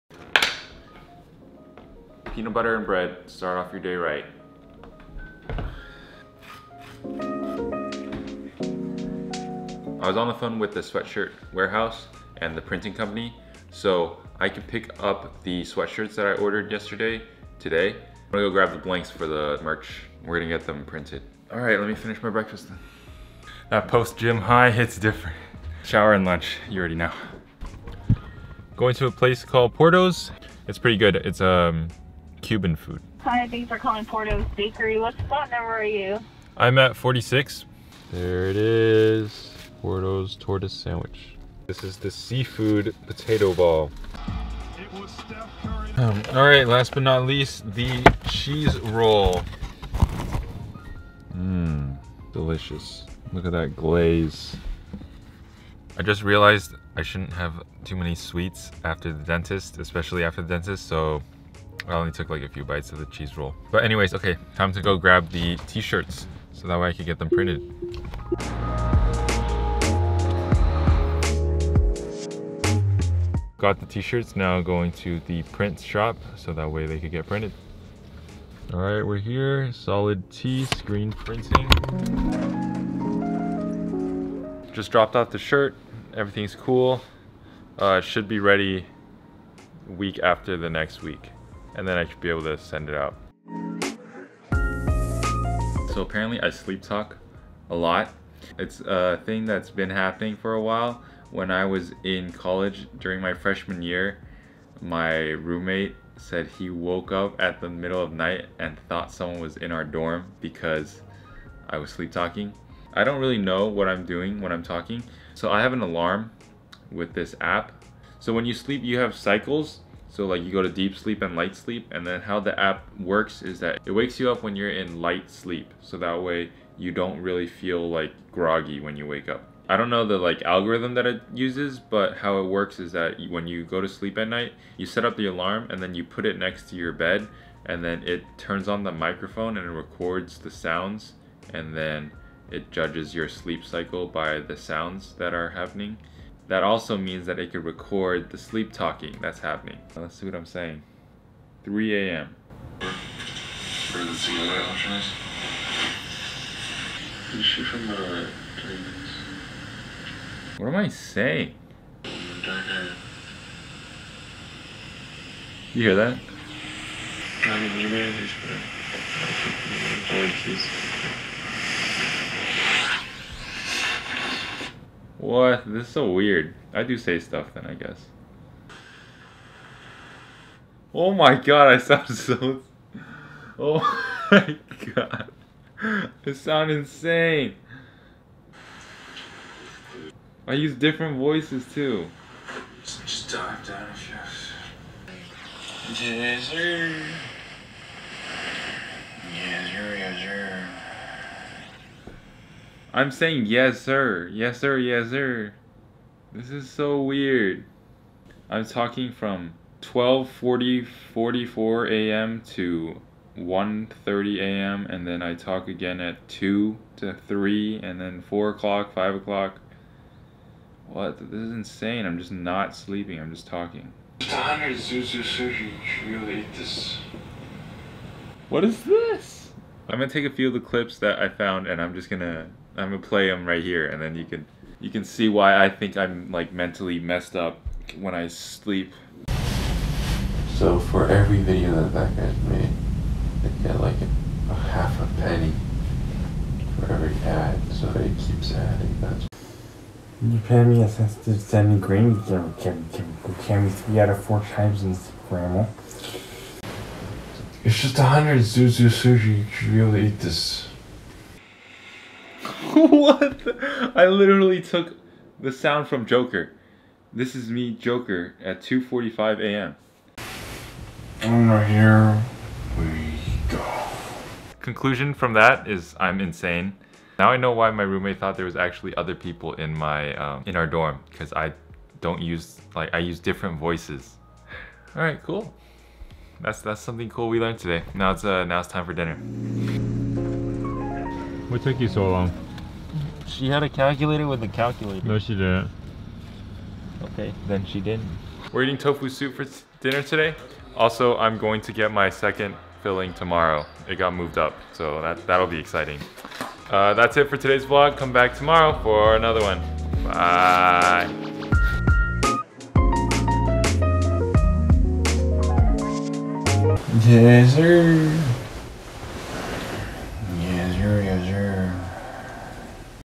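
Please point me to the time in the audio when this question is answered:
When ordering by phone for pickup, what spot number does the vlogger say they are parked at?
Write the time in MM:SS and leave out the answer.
00:36.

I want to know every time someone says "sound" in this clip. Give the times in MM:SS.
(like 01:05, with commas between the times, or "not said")
02:20, 02:24, 03:01, 03:06, 04:25.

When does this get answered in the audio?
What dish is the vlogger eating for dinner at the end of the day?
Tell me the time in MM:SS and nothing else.
04:58.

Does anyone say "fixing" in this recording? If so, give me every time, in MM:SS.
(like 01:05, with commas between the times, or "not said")
not said.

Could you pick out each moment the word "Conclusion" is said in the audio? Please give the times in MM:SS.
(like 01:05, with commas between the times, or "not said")
04:34.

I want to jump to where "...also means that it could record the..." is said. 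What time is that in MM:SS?
02:26.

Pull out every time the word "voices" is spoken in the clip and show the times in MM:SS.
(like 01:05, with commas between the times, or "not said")
03:11, 04:43.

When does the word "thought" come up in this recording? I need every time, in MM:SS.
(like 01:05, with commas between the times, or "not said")
01:48, 04:38.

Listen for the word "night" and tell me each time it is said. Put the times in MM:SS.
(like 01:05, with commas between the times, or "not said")
01:48, 02:14.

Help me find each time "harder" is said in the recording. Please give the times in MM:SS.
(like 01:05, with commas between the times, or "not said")
not said.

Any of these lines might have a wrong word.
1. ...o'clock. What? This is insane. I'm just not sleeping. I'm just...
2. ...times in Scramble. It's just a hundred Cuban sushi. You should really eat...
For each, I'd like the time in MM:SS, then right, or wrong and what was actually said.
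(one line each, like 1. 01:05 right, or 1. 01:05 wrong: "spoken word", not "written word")
1. 03:39 right
2. 04:14 wrong: "Zuzu", not "Cuban".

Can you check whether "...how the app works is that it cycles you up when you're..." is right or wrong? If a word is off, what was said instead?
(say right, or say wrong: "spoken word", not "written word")
wrong: "wakes", not "cycles".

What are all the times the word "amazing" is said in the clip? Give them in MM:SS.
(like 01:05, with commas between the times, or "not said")
not said.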